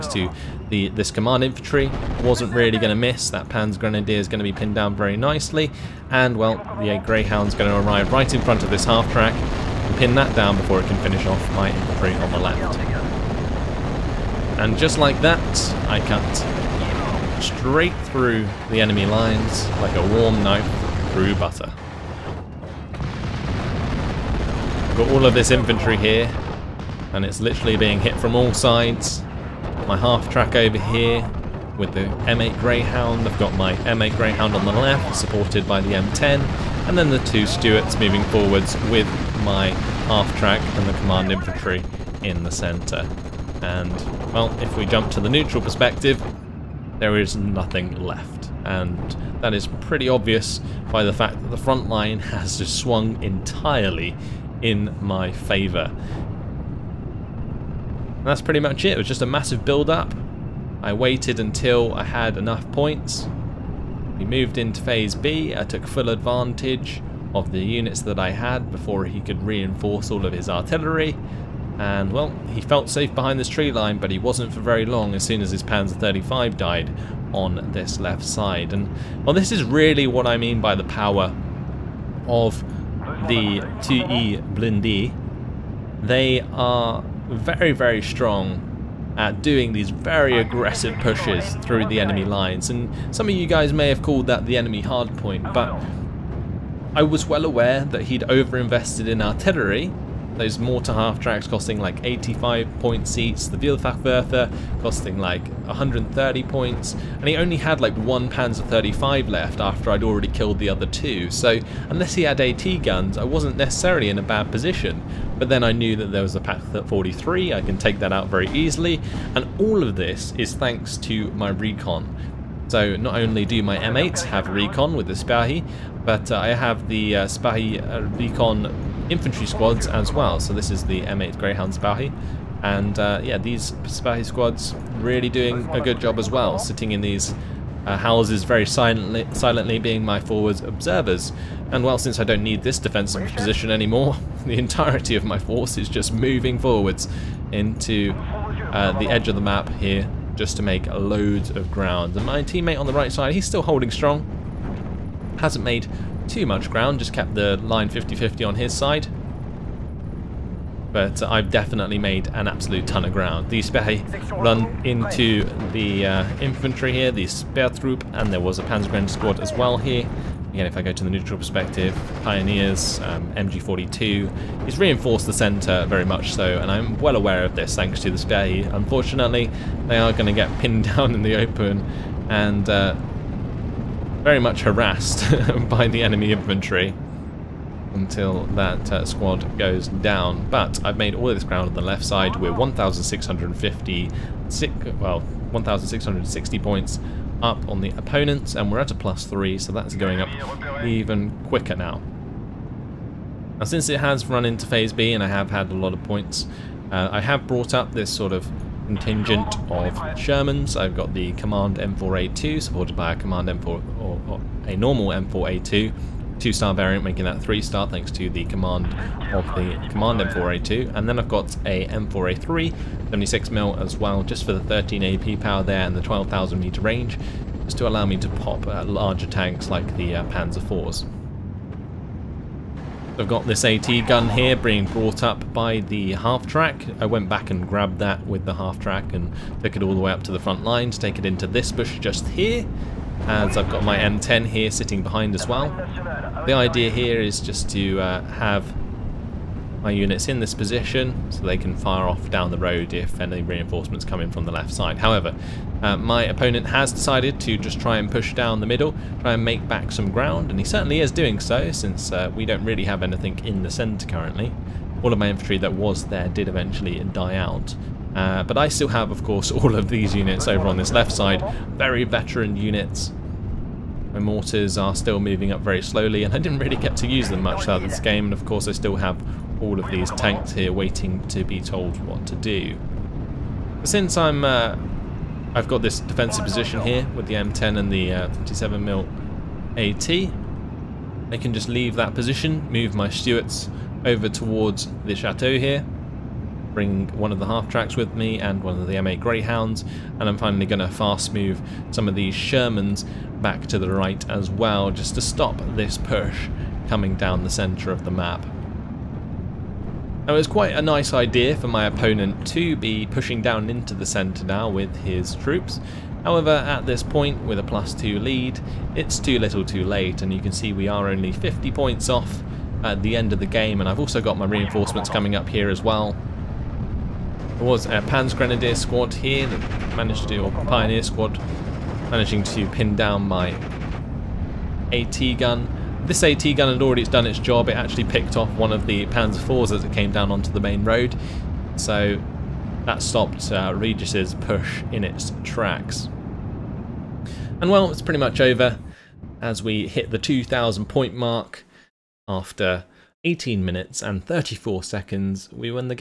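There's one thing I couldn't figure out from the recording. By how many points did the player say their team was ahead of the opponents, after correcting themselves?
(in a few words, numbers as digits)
1,660.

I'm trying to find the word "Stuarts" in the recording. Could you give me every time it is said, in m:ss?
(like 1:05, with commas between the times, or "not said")
0:37, 4:53.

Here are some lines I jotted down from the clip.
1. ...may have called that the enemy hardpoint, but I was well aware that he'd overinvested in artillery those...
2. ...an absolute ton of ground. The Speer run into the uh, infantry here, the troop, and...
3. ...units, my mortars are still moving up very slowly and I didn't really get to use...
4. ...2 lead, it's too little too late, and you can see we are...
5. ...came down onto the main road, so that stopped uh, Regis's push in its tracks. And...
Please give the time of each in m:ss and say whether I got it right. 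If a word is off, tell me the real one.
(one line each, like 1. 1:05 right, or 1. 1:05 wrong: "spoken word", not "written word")
1. 1:33 right
2. 2:42 right
3. 4:32 right
4. 5:17 right
5. 5:39 right.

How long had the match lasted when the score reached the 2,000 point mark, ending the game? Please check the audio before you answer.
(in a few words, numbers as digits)
18 minutes 34 seconds.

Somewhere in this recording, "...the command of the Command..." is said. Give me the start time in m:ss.
3:38.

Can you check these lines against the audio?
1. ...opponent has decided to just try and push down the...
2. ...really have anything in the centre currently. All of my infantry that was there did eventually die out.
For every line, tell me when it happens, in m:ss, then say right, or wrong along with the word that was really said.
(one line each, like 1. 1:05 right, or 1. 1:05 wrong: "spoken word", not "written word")
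1. 4:16 right
2. 4:22 right.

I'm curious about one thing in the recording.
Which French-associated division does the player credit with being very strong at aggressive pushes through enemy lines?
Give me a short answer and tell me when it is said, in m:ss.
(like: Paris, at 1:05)
2e Blindé, at 1:23.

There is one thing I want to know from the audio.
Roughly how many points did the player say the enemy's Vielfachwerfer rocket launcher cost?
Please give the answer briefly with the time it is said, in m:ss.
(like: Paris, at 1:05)
130, at 1:45.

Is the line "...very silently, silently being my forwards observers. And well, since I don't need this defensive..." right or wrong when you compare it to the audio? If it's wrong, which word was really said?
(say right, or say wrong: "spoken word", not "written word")
right.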